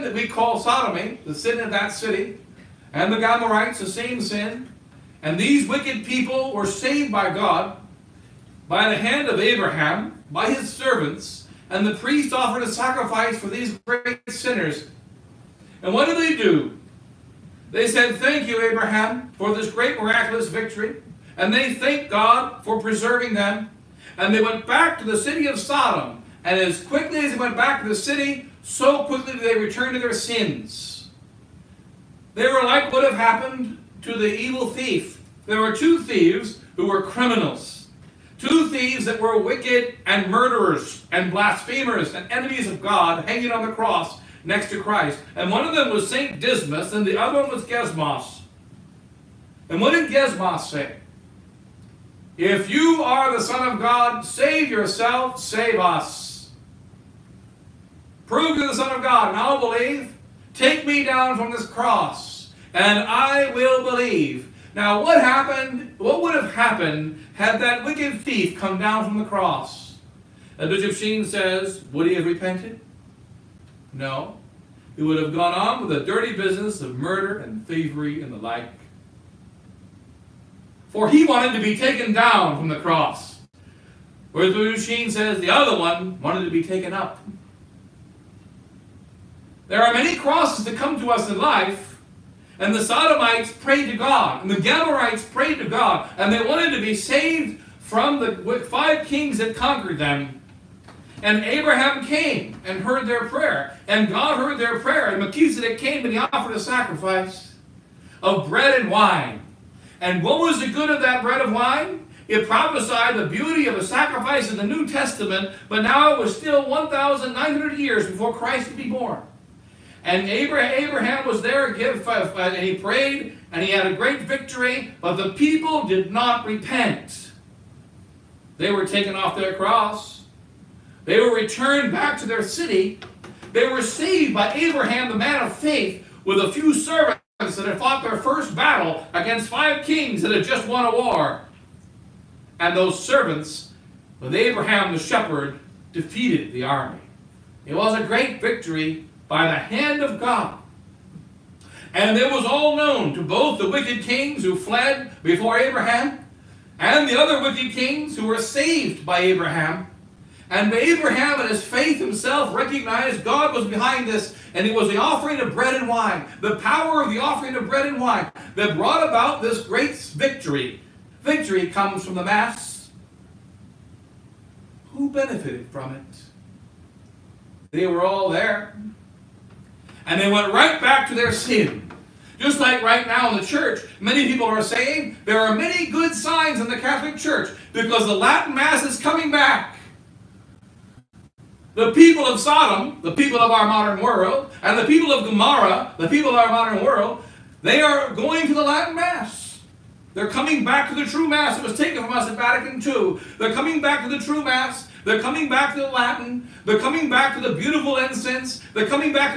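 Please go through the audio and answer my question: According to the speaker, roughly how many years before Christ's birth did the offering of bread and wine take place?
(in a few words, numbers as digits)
1,900.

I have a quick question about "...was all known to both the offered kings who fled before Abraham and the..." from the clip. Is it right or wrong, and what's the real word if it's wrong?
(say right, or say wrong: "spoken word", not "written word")
wrong: "wicked", not "offered".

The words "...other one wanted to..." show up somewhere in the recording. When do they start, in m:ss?
1:25.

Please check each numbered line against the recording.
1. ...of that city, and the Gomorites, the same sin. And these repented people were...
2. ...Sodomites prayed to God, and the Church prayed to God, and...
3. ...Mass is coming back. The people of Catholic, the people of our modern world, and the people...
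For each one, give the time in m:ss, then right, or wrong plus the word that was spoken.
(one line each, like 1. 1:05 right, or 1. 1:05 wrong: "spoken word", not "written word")
1. 0:01 wrong: "wicked", not "repented"
2. 1:32 wrong: "Gamorites", not "Church"
3. 3:08 wrong: "Sodom", not "Catholic".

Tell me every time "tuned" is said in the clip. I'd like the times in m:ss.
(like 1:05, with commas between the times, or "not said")
not said.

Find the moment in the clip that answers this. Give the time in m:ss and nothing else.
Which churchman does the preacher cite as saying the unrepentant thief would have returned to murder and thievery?
1:10.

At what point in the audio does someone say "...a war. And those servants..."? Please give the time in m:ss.
2:20.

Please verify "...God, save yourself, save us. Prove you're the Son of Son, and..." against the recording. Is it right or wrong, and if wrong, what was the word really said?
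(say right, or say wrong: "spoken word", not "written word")
wrong: "God", not "Son".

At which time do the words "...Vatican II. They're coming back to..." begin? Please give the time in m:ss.
3:22.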